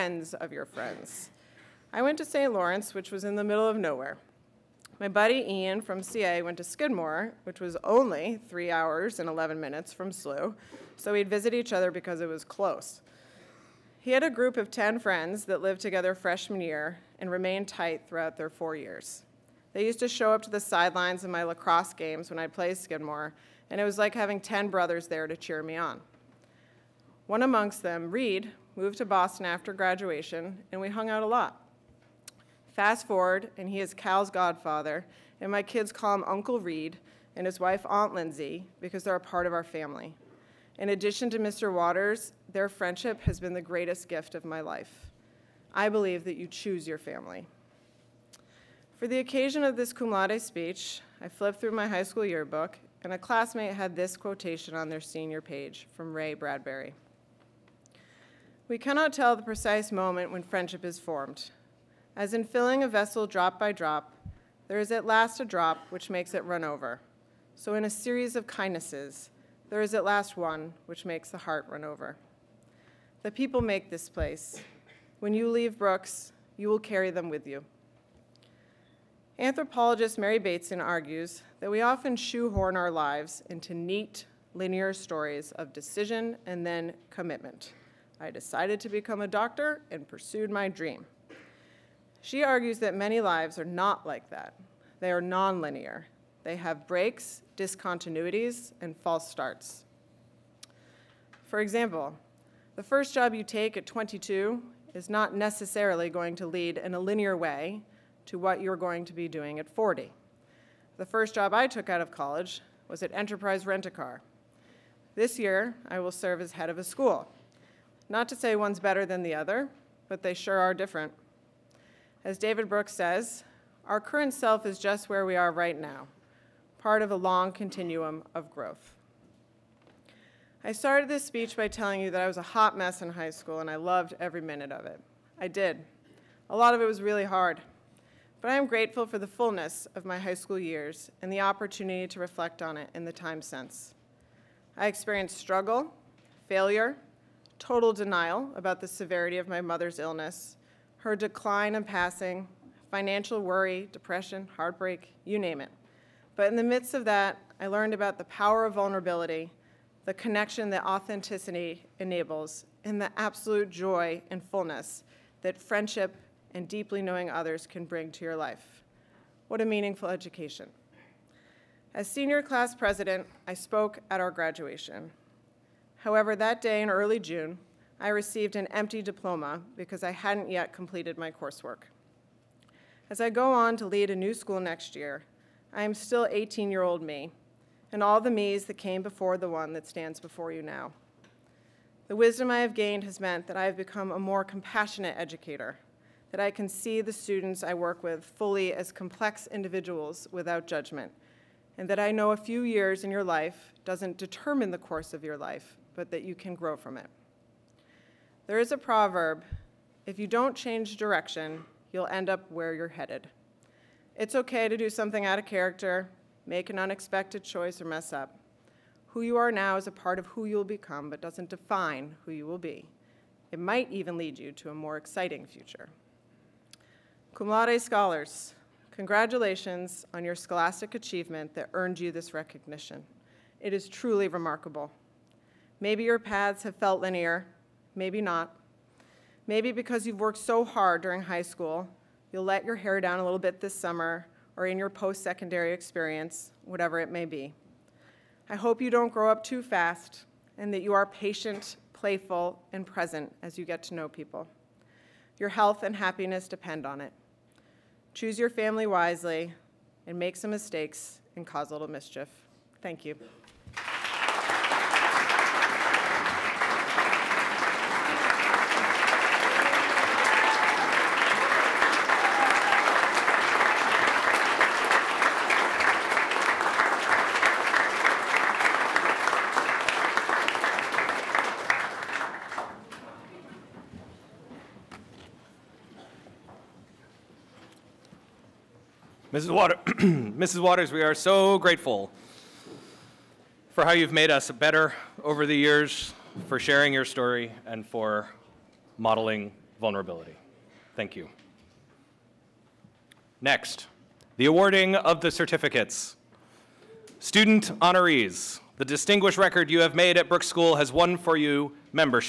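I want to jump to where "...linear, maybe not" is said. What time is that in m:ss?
3:57.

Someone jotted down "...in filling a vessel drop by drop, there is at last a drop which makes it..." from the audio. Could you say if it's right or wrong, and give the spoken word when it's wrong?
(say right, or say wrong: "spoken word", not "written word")
right.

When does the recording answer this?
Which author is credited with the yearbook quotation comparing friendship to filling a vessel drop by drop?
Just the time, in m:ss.
0:56.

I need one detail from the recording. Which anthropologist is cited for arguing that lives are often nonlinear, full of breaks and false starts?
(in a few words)
Mary Bateson.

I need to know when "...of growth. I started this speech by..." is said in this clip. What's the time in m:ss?
2:08.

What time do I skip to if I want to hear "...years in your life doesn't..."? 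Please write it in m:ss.
3:22.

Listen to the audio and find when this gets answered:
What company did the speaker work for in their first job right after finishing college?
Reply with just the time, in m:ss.
1:53.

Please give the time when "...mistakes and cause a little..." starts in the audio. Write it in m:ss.
4:20.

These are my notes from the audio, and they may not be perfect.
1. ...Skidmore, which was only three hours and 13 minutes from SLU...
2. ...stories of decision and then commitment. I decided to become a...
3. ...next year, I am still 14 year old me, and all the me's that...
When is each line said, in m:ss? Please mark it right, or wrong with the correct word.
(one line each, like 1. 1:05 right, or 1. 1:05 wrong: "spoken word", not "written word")
1. 0:06 wrong: "11", not "13"
2. 1:24 right
3. 3:04 wrong: "18", not "14".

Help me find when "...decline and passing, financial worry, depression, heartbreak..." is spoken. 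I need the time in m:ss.
2:31.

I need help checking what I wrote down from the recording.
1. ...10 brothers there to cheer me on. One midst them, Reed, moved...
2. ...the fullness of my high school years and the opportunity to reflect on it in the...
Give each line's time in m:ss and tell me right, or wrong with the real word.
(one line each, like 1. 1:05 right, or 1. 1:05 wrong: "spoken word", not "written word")
1. 0:24 wrong: "amongst", not "midst"
2. 2:19 right.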